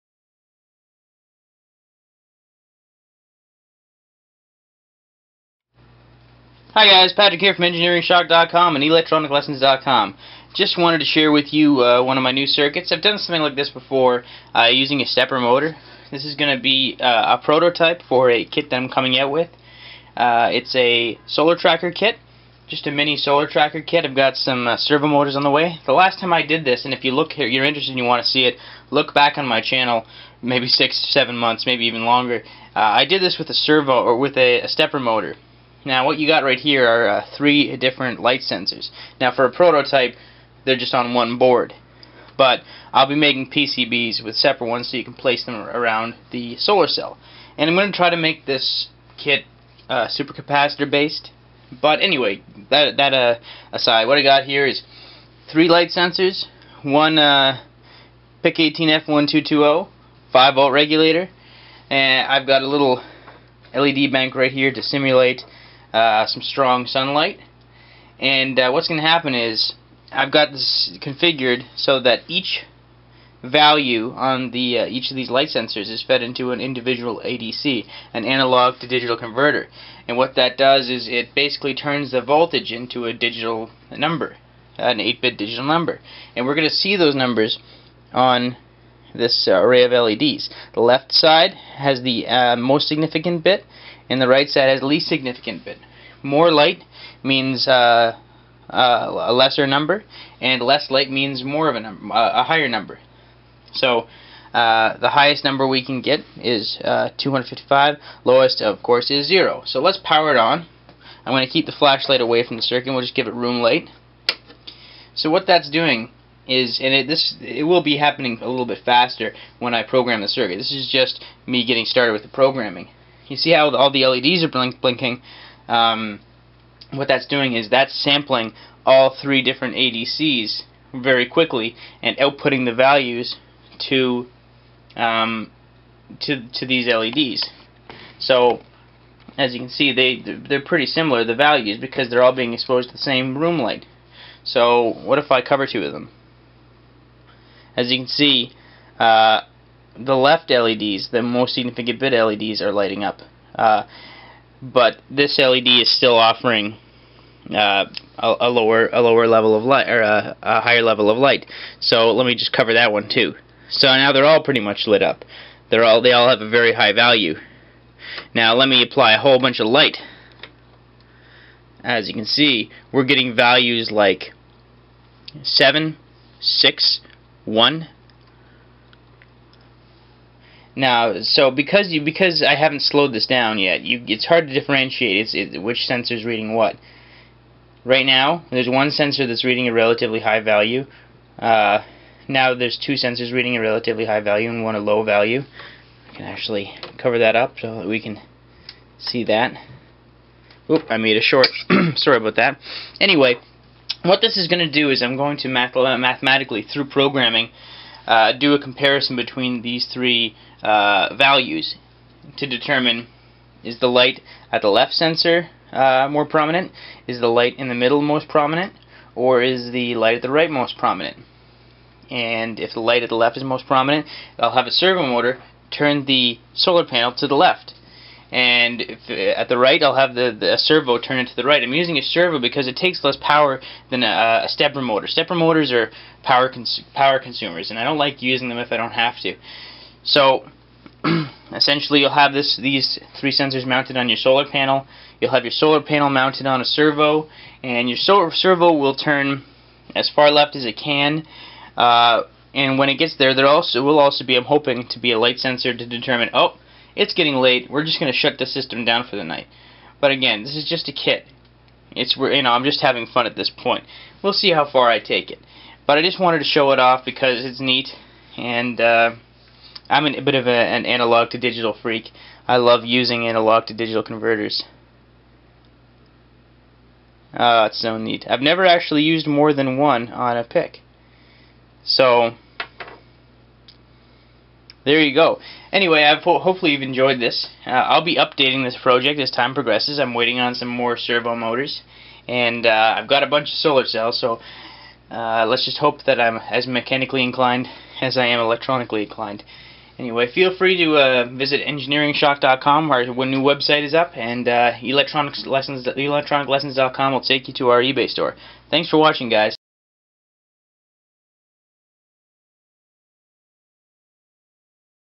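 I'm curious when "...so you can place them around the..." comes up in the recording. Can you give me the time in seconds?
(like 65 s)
44 s.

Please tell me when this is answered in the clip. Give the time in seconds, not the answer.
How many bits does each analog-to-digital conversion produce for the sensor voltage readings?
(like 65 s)
84 s.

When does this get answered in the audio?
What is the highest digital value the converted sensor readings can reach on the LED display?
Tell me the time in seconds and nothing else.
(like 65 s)
106 s.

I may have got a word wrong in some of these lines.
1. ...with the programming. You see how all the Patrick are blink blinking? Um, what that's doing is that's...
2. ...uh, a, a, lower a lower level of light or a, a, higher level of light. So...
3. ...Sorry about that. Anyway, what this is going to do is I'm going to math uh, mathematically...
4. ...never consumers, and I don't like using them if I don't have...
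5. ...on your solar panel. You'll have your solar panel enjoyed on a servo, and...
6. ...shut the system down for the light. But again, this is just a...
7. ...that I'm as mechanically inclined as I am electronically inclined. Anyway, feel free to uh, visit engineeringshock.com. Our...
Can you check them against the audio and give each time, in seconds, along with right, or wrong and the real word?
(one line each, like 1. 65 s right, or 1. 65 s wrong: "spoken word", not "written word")
1. 122 s wrong: "LEDs", not "Patrick"
2. 157 s right
3. 201 s right
4. 236 s wrong: "power", not "never"
5. 243 s wrong: "mounted", not "enjoyed"
6. 258 s wrong: "night", not "light"
7. 296 s right.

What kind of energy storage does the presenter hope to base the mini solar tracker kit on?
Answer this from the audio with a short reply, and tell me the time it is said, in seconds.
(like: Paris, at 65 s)
supercapacitor, at 50 s.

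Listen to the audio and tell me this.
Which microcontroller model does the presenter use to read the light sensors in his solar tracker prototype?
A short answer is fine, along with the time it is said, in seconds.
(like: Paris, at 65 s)
PIC18F1220, at 58 s.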